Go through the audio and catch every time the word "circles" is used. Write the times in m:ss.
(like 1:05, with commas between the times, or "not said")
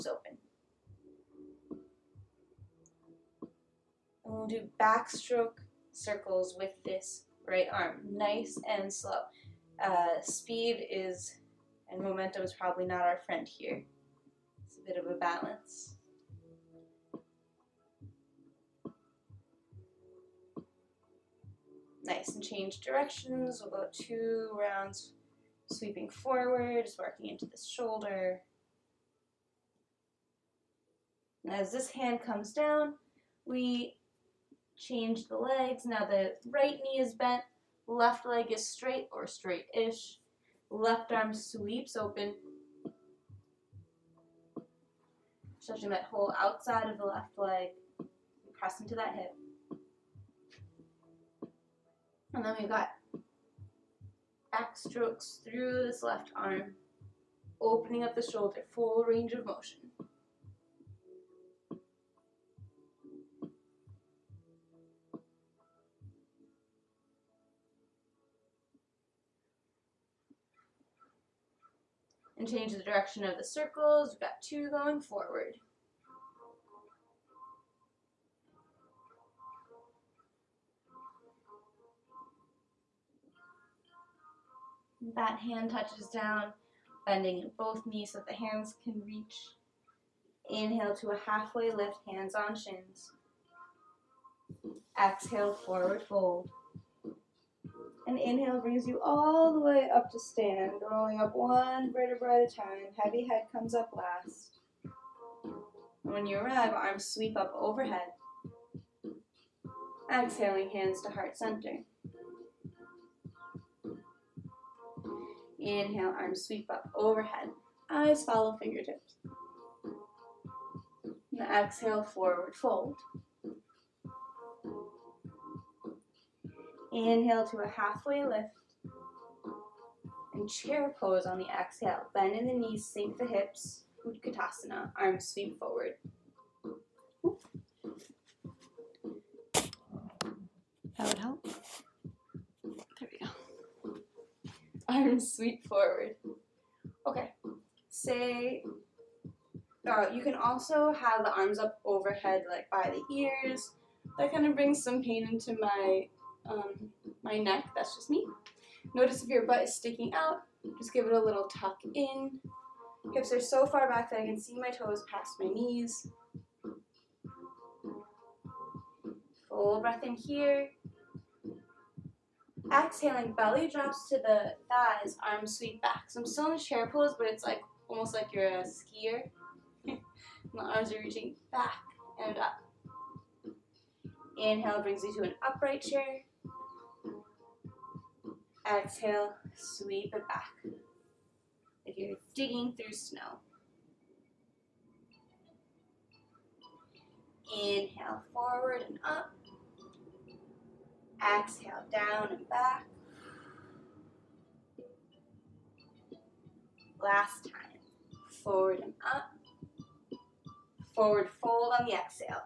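0:05, 1:13.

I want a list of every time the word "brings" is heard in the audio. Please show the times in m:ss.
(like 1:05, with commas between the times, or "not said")
1:38, 2:34, 3:04.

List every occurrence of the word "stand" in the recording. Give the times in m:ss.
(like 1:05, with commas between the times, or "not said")
1:40.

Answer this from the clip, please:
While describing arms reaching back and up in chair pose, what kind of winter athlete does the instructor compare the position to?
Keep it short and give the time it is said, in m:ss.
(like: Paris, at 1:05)
A skier, at 2:58.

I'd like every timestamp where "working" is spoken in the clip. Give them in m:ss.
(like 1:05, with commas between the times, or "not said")
0:26.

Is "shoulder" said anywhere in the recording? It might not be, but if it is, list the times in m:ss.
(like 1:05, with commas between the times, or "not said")
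0:27, 0:58.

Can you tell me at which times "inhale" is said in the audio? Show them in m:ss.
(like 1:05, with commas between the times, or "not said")
1:30, 1:38, 1:55, 2:07, 3:04, 3:17.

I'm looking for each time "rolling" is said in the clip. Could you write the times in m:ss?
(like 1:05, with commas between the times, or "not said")
1:40.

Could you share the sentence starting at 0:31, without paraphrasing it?
And as this hand comes down, we change the legs.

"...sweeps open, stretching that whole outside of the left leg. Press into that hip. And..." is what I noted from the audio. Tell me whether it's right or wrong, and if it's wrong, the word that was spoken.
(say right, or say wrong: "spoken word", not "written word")
right.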